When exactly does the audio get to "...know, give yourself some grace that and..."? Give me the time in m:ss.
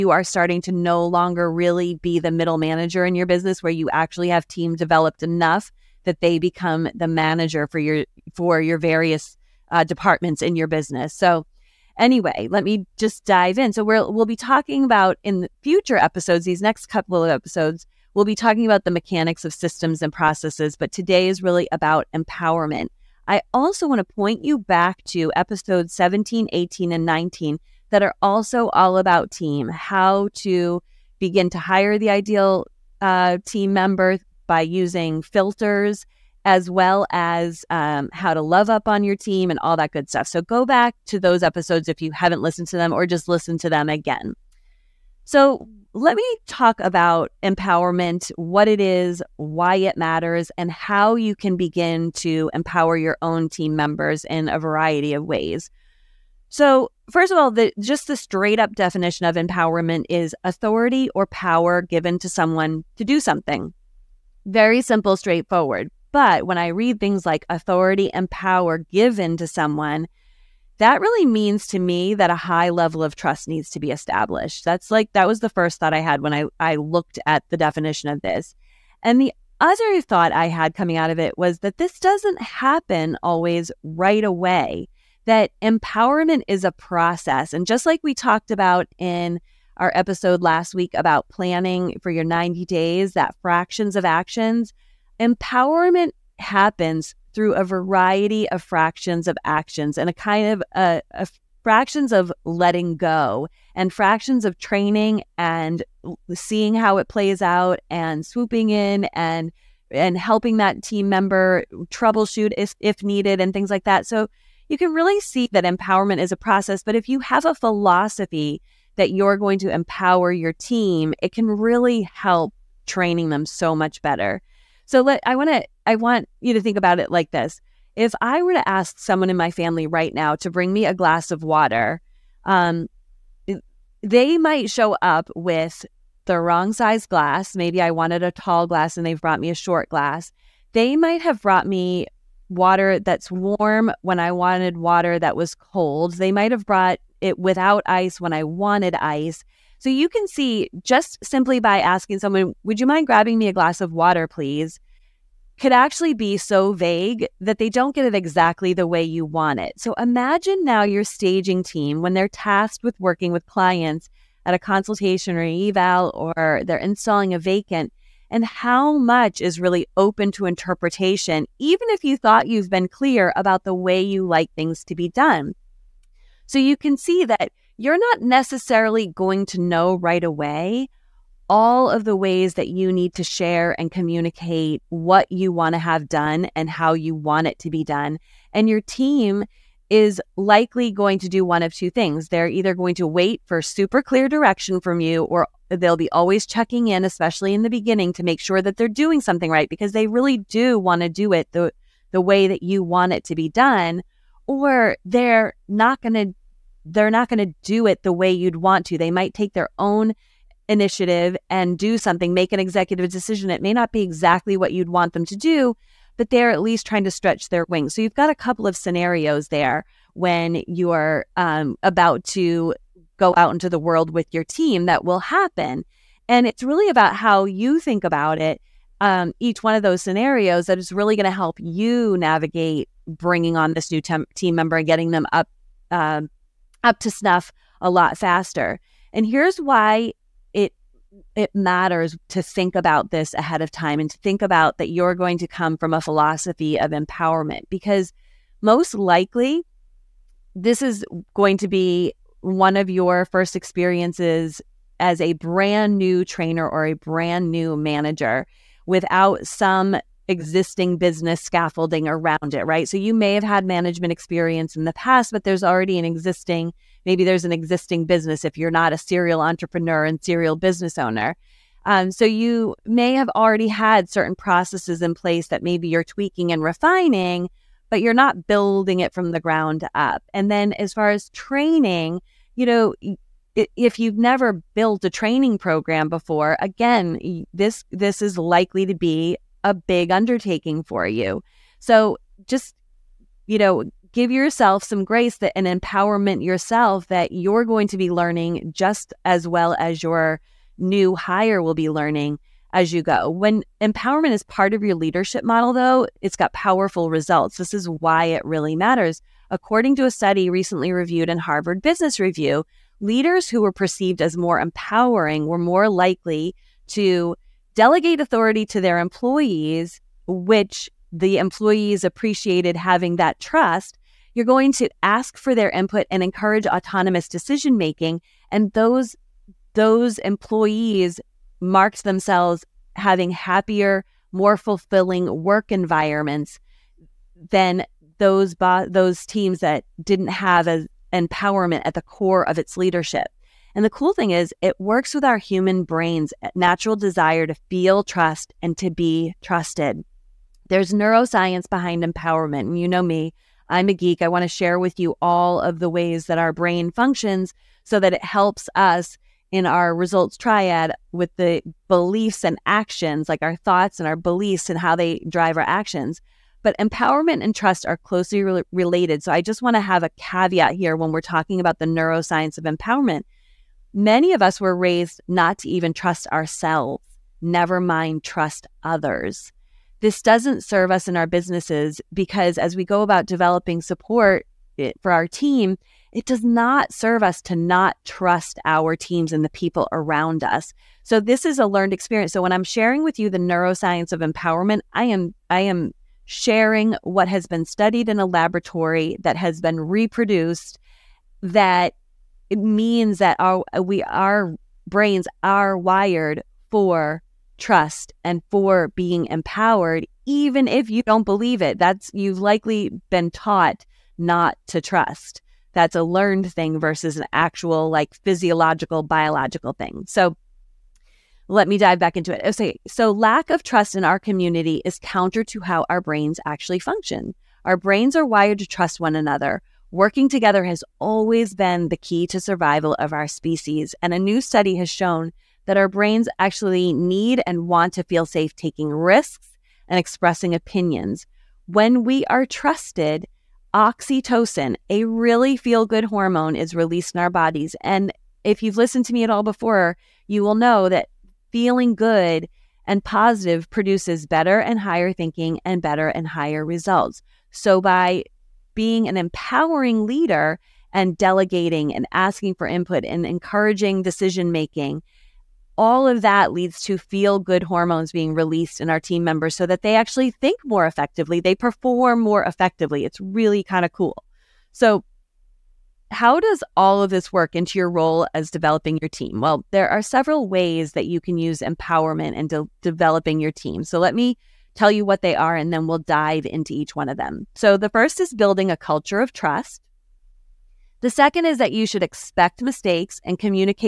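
4:53.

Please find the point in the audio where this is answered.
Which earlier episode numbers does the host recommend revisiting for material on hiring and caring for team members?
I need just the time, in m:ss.
0:25.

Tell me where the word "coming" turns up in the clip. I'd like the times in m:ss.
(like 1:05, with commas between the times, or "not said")
1:20.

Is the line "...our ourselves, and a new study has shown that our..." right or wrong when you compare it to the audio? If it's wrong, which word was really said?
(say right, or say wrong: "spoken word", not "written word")
wrong: "species", not "ourselves".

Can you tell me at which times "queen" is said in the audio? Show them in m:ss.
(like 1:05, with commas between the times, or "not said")
not said.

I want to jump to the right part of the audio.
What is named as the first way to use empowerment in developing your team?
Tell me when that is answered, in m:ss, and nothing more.
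8:08.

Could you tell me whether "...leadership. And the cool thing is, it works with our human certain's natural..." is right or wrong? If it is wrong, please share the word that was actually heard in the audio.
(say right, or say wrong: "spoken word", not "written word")
wrong: "brain", not "certain".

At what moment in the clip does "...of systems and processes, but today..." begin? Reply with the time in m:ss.
0:19.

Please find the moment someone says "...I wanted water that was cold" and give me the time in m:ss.
2:24.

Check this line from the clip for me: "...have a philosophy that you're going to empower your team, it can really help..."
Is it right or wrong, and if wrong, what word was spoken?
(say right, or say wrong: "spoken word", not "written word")
right.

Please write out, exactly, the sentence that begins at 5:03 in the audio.
When empowerment is part of your leadership model, though, it's got powerful results.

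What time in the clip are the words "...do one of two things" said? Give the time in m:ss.
3:11.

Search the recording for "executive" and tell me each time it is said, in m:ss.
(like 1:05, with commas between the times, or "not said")
3:32.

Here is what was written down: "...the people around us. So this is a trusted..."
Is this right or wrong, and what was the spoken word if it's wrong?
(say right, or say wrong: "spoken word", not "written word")
wrong: "learned", not "trusted".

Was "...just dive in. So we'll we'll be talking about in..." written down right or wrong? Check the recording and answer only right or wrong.
right.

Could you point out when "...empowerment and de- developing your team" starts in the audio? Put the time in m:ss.
8:01.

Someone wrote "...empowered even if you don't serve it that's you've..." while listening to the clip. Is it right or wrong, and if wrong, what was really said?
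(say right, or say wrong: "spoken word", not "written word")
wrong: "believe", not "serve".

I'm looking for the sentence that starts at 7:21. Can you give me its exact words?
When we are trusted, oxytocin, a really feel good hormone, is released in our bodies.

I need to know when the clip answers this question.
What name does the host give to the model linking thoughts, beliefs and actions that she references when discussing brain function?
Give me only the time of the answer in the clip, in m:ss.
5:59.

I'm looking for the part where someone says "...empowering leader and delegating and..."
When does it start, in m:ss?
7:39.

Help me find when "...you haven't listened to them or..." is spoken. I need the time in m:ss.
0:42.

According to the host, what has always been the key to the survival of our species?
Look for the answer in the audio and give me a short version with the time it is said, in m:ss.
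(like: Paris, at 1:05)
Working together, at 7:09.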